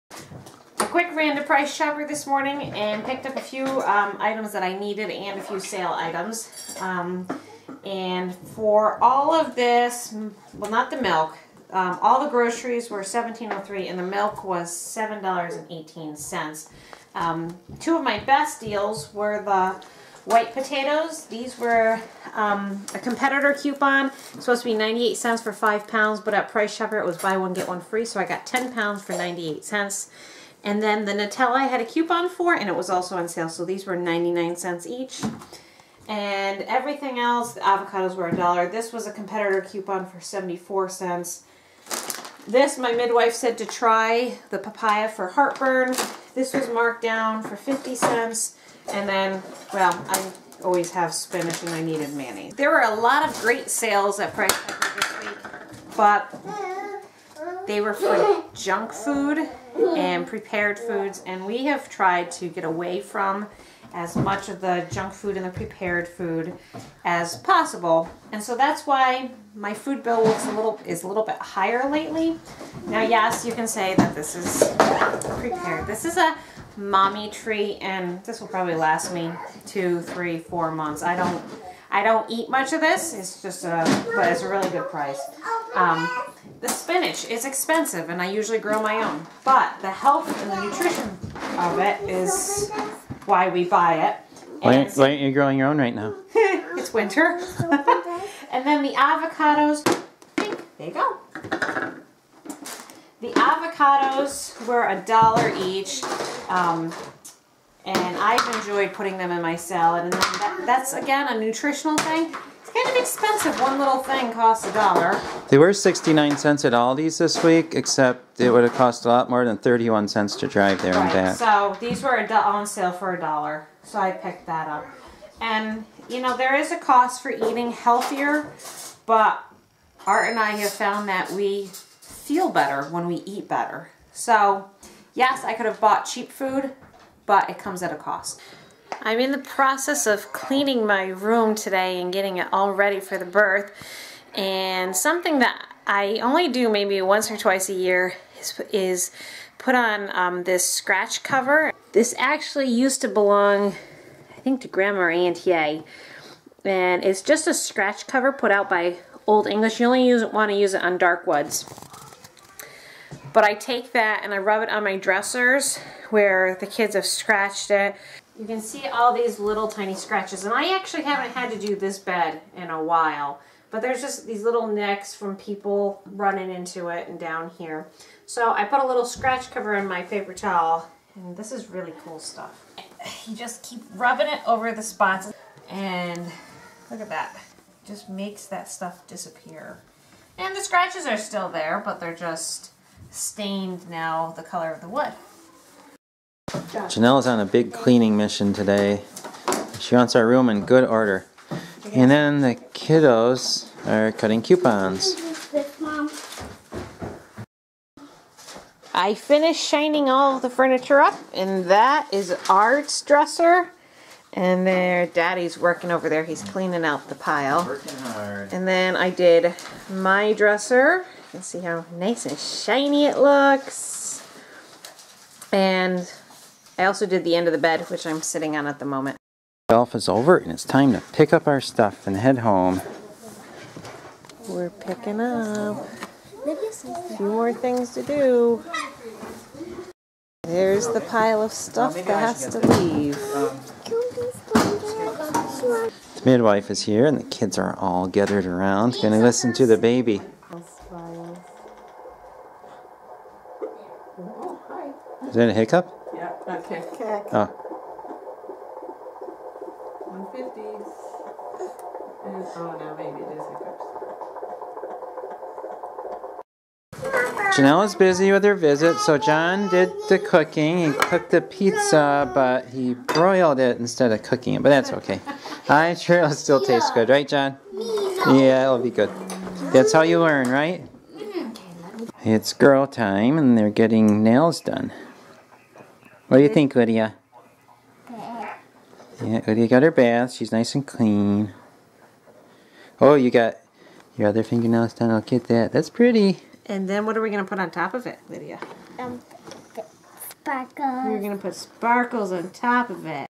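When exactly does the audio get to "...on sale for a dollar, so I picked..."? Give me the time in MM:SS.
02:02.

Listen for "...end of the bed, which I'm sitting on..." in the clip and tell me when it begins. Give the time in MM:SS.
03:47.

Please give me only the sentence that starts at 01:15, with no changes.
This is a mommy treat, and this will probably last me two, three, four months.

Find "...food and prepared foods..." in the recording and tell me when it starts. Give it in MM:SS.
00:58.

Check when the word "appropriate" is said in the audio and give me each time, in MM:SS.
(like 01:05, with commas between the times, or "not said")
not said.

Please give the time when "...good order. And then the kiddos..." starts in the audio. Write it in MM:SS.
03:20.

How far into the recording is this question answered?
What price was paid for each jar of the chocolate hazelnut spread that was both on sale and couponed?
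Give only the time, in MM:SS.
00:33.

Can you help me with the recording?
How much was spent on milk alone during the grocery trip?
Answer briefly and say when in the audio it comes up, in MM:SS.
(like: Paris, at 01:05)
$7.18, at 00:14.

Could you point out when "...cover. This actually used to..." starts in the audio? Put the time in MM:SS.
02:31.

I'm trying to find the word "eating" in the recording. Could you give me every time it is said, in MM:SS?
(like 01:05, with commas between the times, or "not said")
02:07.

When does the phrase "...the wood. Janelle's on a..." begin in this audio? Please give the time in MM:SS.
03:14.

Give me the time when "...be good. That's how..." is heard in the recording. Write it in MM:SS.
04:38.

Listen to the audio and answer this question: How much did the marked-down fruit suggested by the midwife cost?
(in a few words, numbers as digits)
50 cents.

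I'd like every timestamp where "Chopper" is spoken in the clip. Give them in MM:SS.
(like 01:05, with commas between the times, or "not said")
00:01, 00:26.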